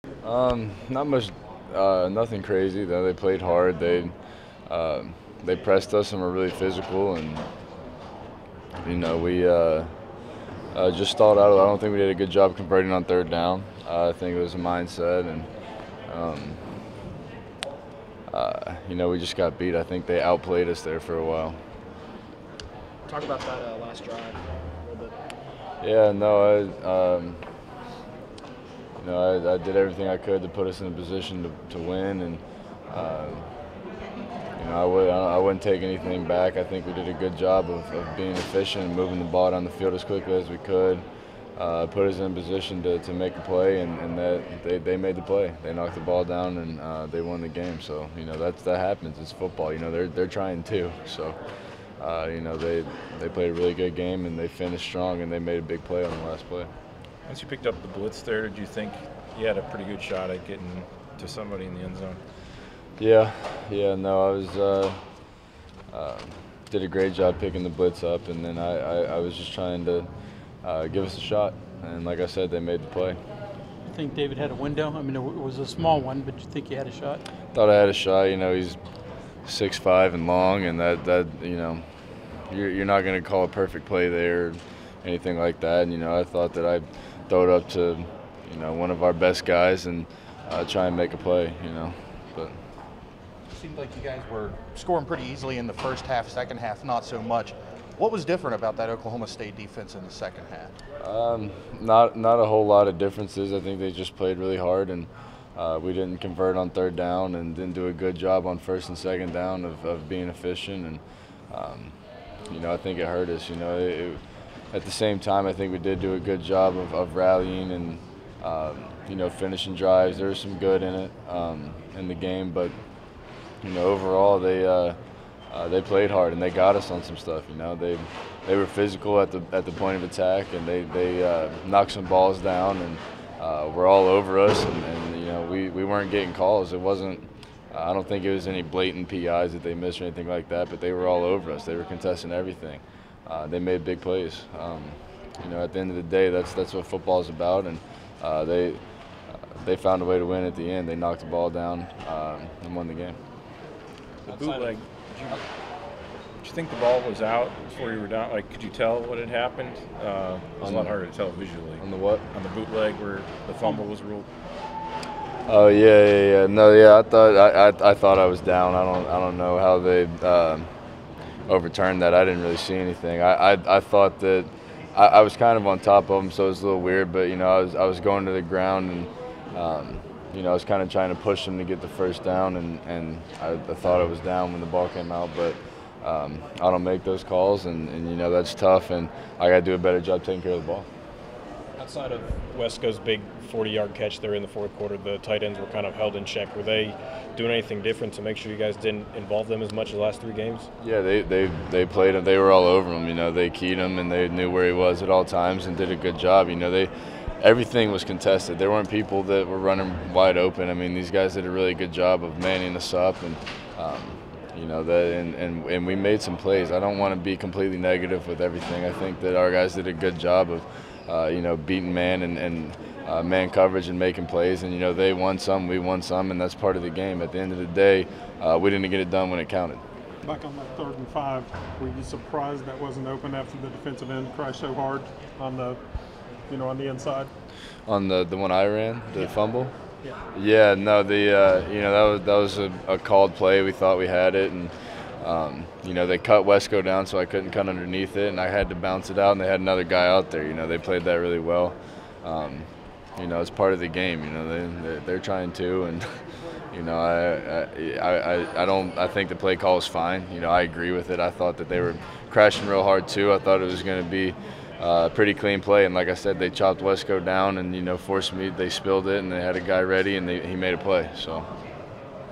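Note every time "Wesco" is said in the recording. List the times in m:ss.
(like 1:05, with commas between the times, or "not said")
3:12, 4:06, 4:26.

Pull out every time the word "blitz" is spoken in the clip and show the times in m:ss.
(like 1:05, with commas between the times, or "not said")
0:57, 1:07.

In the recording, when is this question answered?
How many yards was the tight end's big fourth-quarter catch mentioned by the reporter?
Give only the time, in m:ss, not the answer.
3:13.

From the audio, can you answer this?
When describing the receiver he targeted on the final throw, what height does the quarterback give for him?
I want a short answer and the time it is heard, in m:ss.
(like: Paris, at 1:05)
6'5", at 1:19.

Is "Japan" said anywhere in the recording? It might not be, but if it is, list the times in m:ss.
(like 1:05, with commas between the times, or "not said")
not said.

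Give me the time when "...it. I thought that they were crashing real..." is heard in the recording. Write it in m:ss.
4:21.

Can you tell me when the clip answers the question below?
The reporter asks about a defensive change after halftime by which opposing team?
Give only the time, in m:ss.
1:38.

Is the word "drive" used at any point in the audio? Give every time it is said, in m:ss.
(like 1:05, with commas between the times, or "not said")
0:24, 1:59.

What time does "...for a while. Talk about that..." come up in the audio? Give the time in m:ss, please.
0:21.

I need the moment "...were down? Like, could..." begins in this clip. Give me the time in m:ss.
2:38.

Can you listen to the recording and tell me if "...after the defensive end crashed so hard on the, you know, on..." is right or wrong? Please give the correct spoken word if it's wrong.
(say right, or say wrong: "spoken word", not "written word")
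right.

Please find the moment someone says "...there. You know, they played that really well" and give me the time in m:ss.
4:10.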